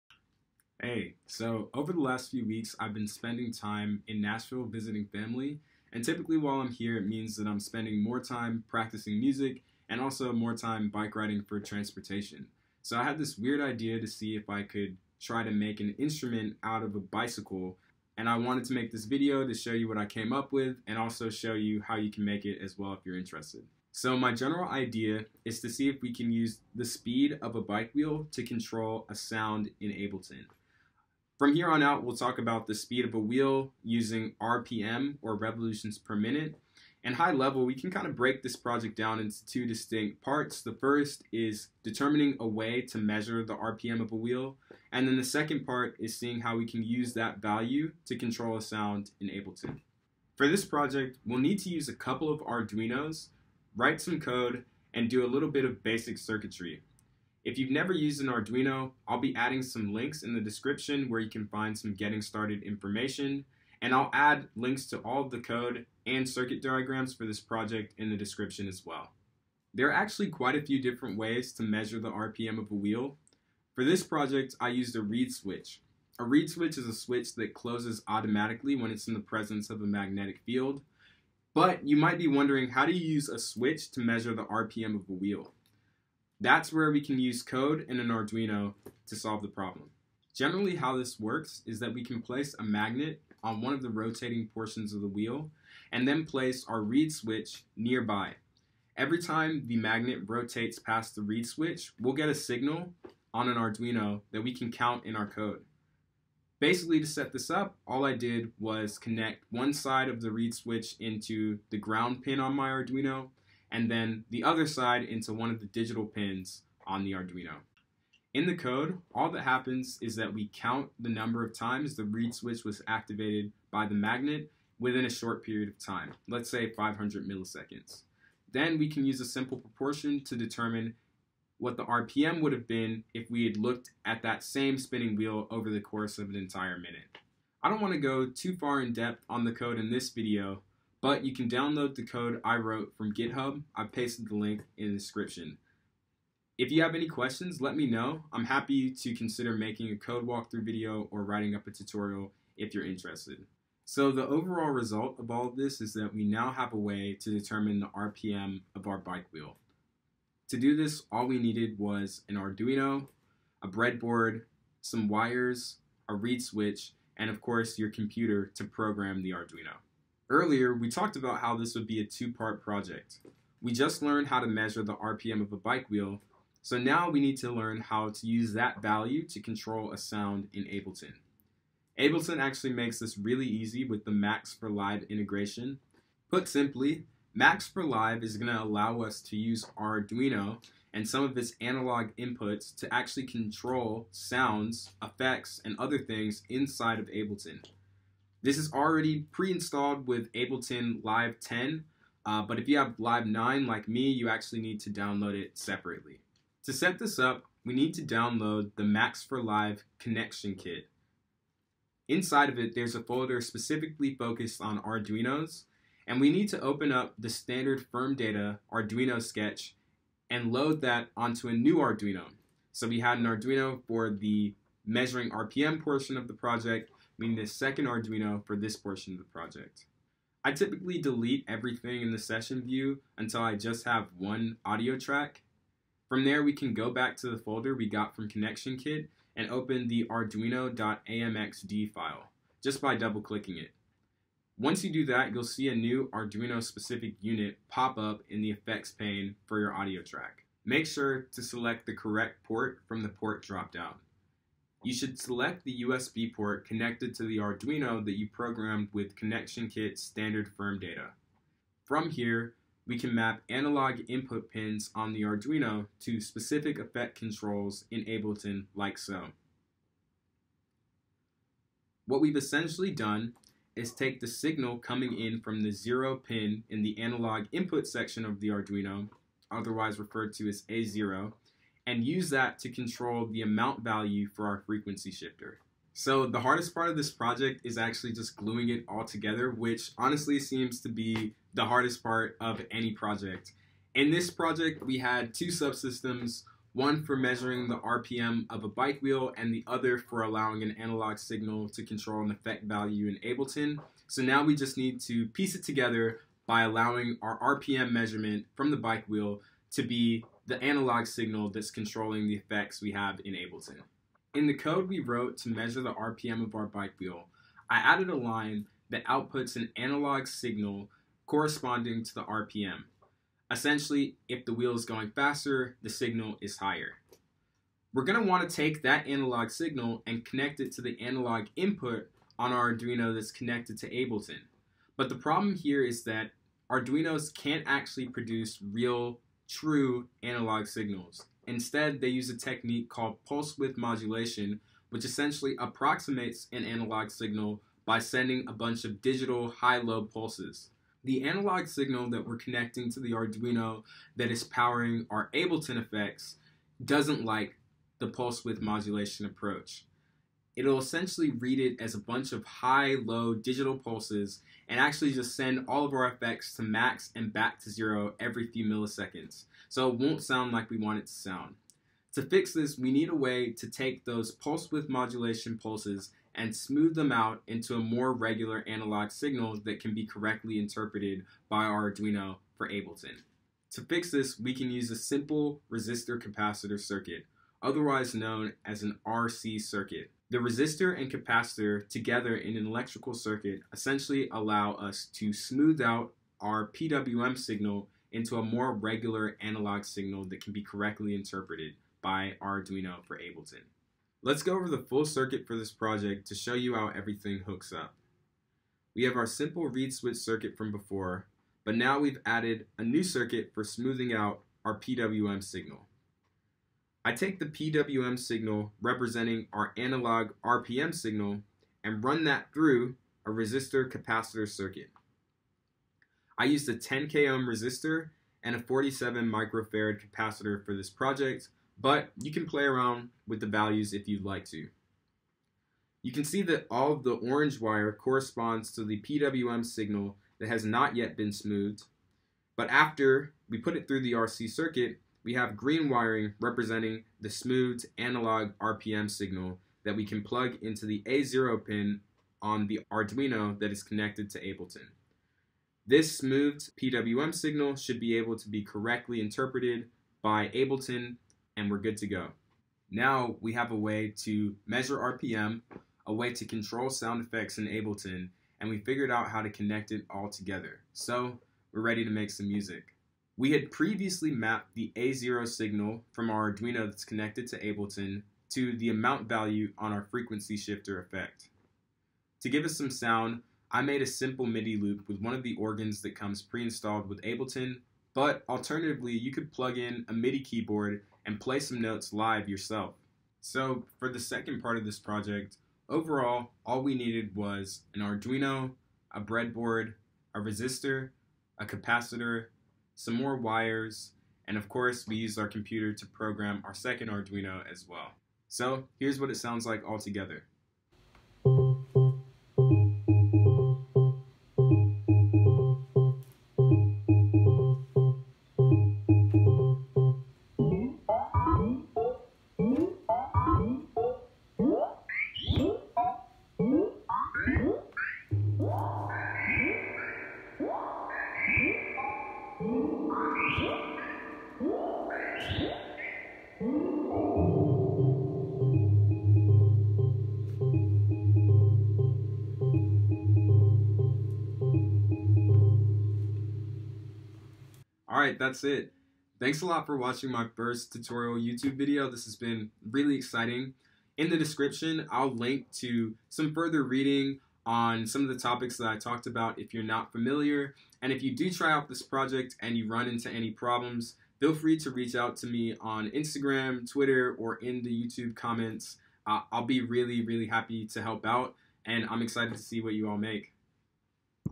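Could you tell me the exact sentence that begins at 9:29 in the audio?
Uh, I'll be really, really happy to help out, and I'm excited to see what you all make.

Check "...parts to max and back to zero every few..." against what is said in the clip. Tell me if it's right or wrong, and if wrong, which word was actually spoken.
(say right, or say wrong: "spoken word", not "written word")
wrong: "effects", not "parts".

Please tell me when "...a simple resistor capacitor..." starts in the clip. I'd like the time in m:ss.
6:24.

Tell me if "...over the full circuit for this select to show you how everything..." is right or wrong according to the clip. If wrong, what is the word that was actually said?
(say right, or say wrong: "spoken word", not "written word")
wrong: "project", not "select".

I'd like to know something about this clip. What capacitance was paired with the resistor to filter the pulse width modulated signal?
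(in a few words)
47 microfarads.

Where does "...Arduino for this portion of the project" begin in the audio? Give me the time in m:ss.
3:47.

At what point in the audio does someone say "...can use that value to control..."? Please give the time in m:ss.
0:46.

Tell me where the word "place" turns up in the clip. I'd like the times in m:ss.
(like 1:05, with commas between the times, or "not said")
1:32, 1:36.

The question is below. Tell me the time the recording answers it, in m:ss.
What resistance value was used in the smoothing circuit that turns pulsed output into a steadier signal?
7:06.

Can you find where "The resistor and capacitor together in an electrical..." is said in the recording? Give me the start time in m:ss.
6:30.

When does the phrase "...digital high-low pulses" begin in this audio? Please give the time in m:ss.
5:49.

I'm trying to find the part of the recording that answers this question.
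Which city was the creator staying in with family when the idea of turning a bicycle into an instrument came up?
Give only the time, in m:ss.
0:04.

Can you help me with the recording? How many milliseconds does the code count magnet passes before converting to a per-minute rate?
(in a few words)
500.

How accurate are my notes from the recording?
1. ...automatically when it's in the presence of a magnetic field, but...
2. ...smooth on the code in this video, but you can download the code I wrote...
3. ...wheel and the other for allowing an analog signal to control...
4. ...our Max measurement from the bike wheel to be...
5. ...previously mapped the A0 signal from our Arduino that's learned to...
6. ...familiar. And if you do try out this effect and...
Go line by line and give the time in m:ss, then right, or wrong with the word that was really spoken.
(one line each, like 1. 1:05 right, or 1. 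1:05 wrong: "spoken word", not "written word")
1. 1:18 right
2. 2:18 wrong: "depth", not "smooth"
3. 4:59 right
4. 5:07 wrong: "RPM", not "Max"
5. 7:53 wrong: "connected", not "learned"
6. 9:20 wrong: "project", not "effect".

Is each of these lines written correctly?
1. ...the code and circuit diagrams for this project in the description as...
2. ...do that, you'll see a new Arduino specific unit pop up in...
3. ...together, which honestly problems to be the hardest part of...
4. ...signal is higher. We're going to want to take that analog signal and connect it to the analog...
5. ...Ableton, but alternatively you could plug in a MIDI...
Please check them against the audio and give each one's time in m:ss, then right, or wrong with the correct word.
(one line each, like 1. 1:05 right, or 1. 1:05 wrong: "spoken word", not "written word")
1. 1:05 right
2. 4:04 right
3. 4:49 wrong: "seems", not "problems"
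4. 5:25 right
5. 8:07 right.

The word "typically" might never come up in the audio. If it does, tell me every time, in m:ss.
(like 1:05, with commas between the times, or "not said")
0:06, 3:50.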